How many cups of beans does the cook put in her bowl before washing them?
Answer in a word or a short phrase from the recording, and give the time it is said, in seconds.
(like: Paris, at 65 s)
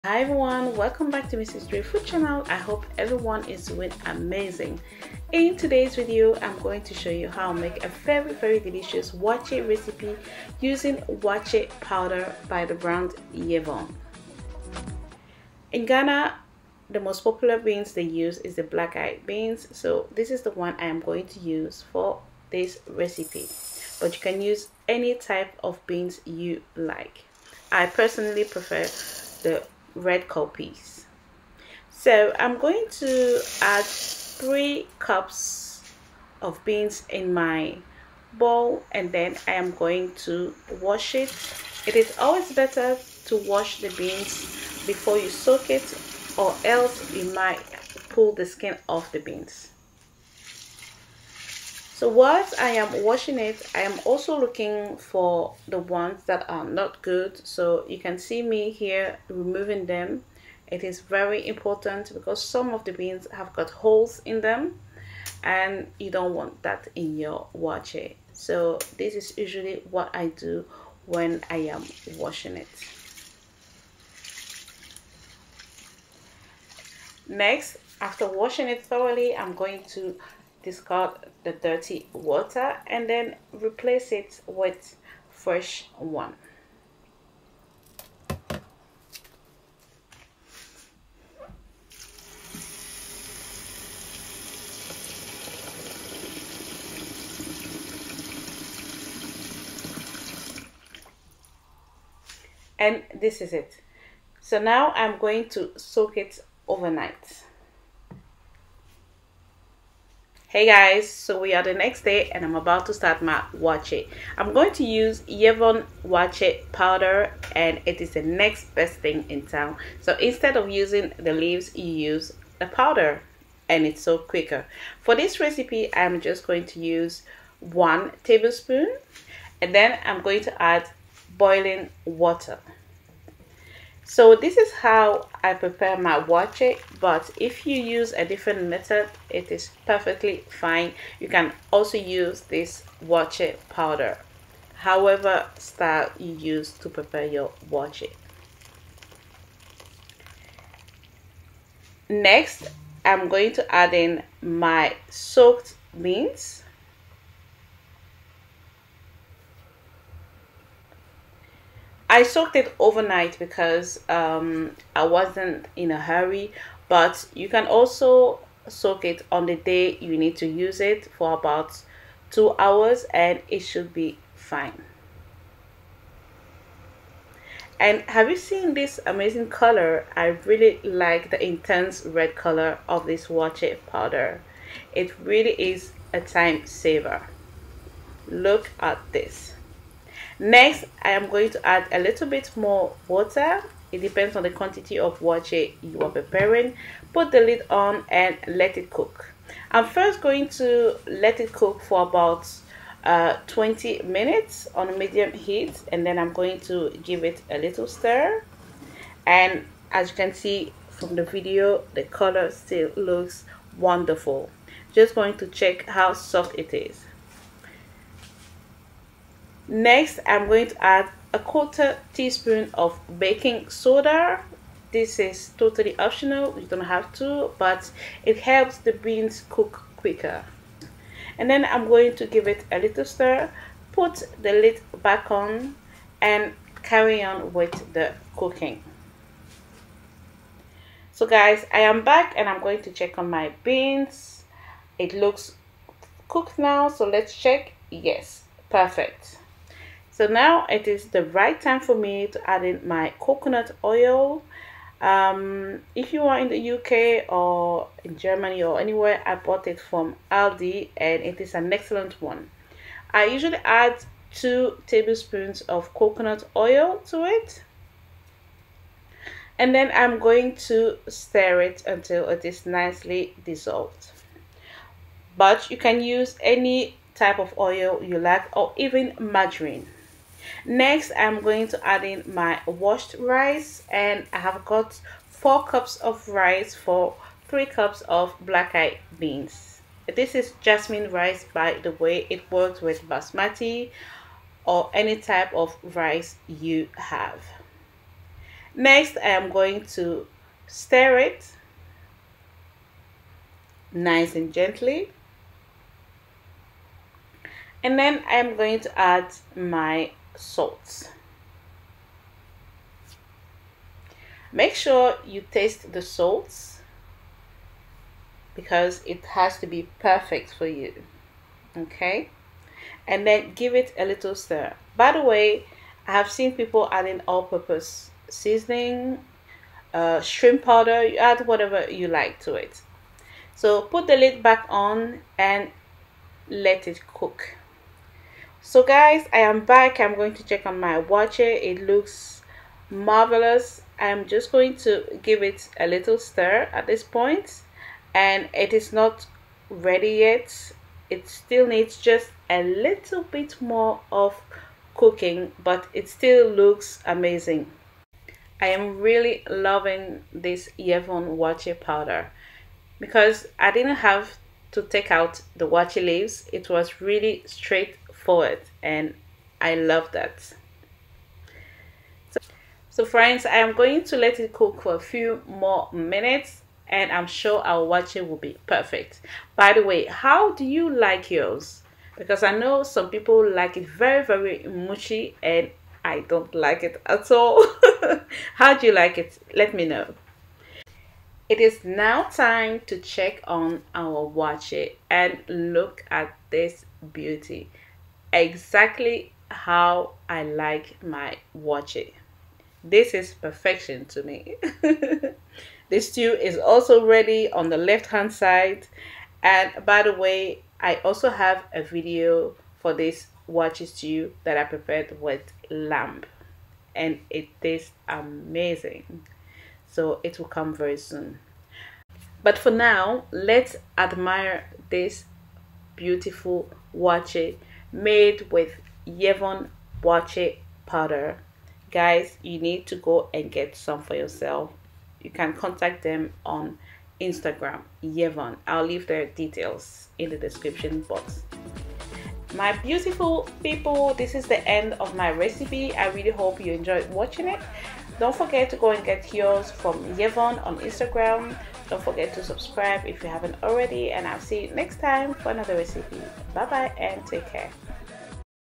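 3, at 33 s.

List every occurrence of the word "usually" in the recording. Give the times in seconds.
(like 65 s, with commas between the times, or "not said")
69 s, 263 s.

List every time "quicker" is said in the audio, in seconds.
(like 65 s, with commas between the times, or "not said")
124 s, 229 s.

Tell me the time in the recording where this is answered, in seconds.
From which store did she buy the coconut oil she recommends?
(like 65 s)
260 s.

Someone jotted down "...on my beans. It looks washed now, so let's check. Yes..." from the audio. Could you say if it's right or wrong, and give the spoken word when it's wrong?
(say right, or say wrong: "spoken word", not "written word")
wrong: "cooked", not "washed".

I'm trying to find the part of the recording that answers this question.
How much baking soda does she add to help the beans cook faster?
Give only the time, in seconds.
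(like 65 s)
221 s.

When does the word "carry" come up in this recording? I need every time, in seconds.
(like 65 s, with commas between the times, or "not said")
236 s.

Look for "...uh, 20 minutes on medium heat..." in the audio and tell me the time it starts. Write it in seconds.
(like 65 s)
203 s.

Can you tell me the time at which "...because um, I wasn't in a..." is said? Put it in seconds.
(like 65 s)
163 s.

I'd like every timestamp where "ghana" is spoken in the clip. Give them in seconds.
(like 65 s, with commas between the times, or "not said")
15 s.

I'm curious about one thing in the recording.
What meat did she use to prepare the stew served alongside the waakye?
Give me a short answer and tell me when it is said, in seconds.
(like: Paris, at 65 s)
lamb, at 415 s.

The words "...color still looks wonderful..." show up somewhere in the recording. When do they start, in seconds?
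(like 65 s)
212 s.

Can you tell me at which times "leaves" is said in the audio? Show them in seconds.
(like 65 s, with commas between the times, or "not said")
121 s, 366 s, 438 s.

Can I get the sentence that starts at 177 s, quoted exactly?
And have you seen this amazing color?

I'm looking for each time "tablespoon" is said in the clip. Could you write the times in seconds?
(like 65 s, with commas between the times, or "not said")
128 s, 264 s.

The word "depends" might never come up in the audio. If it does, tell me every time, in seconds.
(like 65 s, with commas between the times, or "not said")
193 s.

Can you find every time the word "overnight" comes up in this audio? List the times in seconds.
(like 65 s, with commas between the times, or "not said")
106 s, 162 s.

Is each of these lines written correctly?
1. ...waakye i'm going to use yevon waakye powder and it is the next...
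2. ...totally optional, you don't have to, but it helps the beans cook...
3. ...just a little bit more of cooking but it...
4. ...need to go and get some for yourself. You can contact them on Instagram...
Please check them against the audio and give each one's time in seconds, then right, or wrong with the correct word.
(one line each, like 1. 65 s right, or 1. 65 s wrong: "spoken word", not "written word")
1. 113 s right
2. 225 s right
3. 351 s right
4. 432 s right.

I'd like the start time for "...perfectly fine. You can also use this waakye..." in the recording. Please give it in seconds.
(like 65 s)
139 s.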